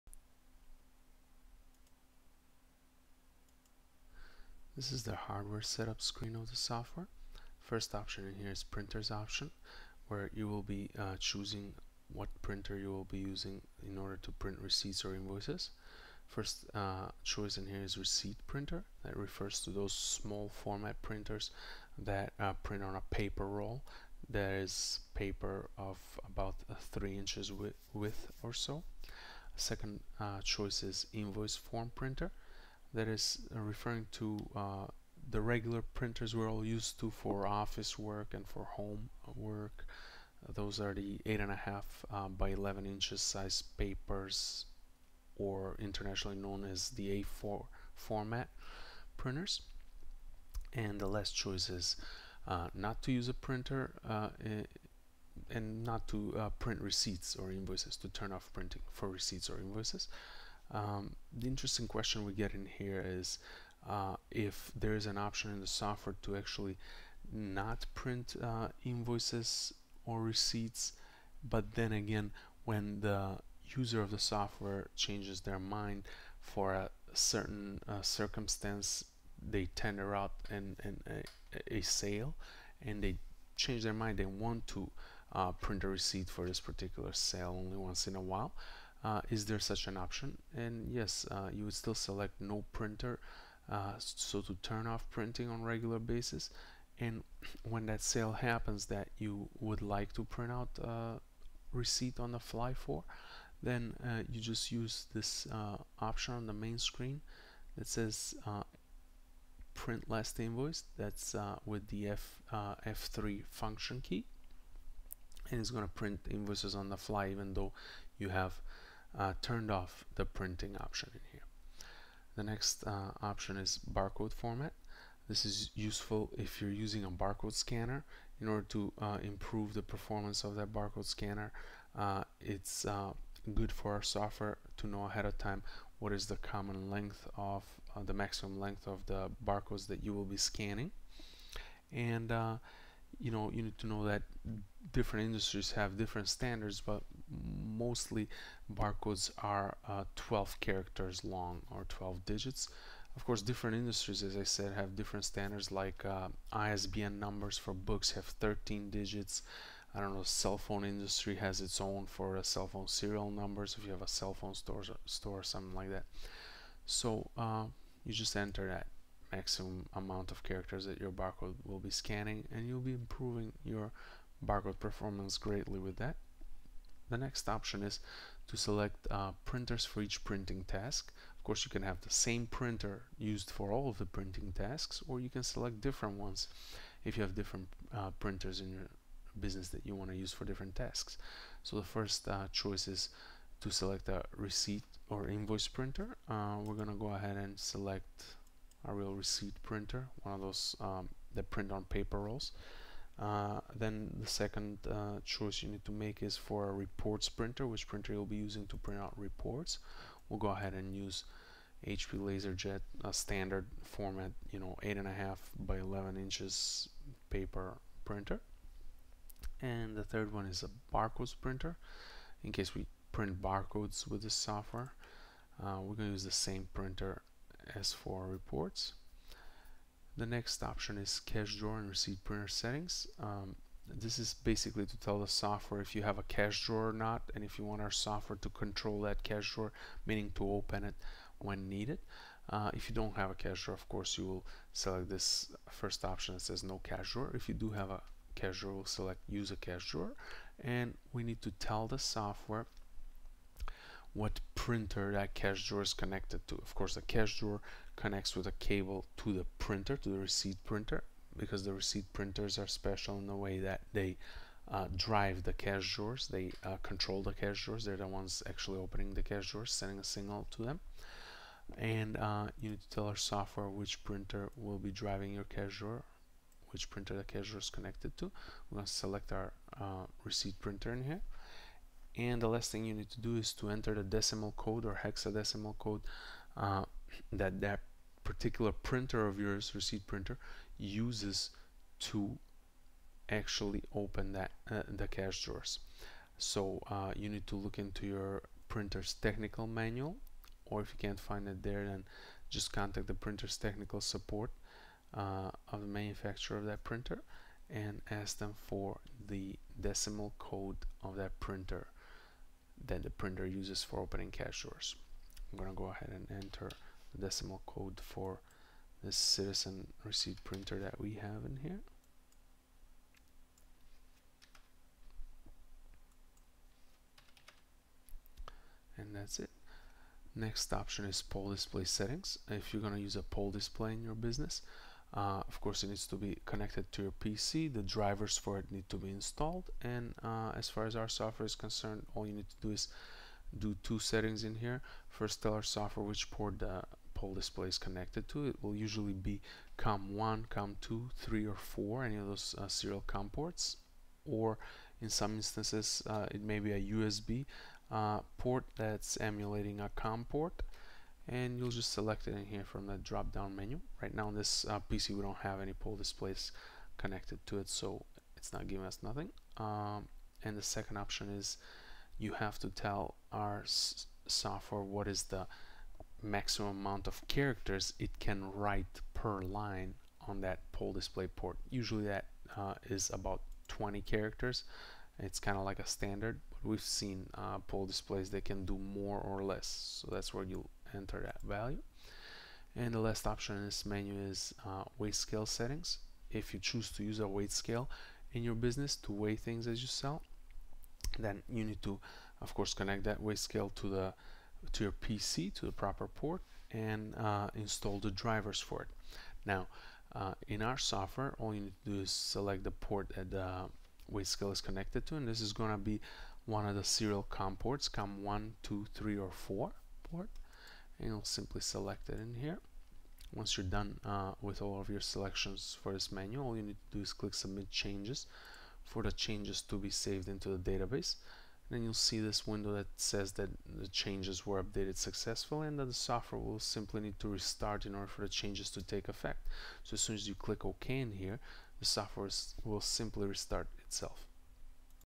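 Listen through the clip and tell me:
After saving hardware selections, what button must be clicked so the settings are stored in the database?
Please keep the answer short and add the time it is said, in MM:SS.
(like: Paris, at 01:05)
Submit changes, at 07:07.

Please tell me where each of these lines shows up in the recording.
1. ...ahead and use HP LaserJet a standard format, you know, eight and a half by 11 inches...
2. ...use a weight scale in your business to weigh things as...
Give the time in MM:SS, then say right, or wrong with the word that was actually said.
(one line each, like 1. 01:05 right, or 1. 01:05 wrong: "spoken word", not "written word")
1. 03:30 right
2. 06:37 right.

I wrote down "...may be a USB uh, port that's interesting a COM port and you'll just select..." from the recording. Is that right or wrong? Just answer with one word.
wrong.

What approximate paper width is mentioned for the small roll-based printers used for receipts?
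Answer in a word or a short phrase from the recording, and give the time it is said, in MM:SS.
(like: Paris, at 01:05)
3 inches, at 00:26.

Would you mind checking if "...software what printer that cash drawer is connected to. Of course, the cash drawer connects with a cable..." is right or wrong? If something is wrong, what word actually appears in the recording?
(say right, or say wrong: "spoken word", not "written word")
right.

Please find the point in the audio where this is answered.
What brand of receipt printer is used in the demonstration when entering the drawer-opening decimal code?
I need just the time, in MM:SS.
05:19.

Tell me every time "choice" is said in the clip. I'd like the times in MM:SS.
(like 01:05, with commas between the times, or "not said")
00:17, 00:30, 00:51, 03:12, 03:25.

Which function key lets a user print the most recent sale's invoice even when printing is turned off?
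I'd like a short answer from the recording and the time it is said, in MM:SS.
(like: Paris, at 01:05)
F3, at 01:52.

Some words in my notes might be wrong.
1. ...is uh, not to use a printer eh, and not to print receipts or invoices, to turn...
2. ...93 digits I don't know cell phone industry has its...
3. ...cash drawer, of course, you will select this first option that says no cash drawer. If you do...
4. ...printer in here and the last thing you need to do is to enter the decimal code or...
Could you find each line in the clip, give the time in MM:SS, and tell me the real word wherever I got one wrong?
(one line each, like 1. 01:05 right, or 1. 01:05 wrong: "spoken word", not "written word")
1. 00:51 right
2. 02:38 wrong: "13", not "93"
3. 04:03 right
4. 04:40 right.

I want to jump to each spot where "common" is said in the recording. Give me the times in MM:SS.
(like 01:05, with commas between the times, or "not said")
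02:16.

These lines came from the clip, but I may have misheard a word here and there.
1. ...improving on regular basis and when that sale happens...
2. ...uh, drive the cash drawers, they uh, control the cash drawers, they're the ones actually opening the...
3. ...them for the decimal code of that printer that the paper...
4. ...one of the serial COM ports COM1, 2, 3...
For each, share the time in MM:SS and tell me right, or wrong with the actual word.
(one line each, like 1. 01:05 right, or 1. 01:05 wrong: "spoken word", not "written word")
1. 01:35 wrong: "printing", not "improving"
2. 04:24 right
3. 05:08 wrong: "printer", not "paper"
4. 06:56 right.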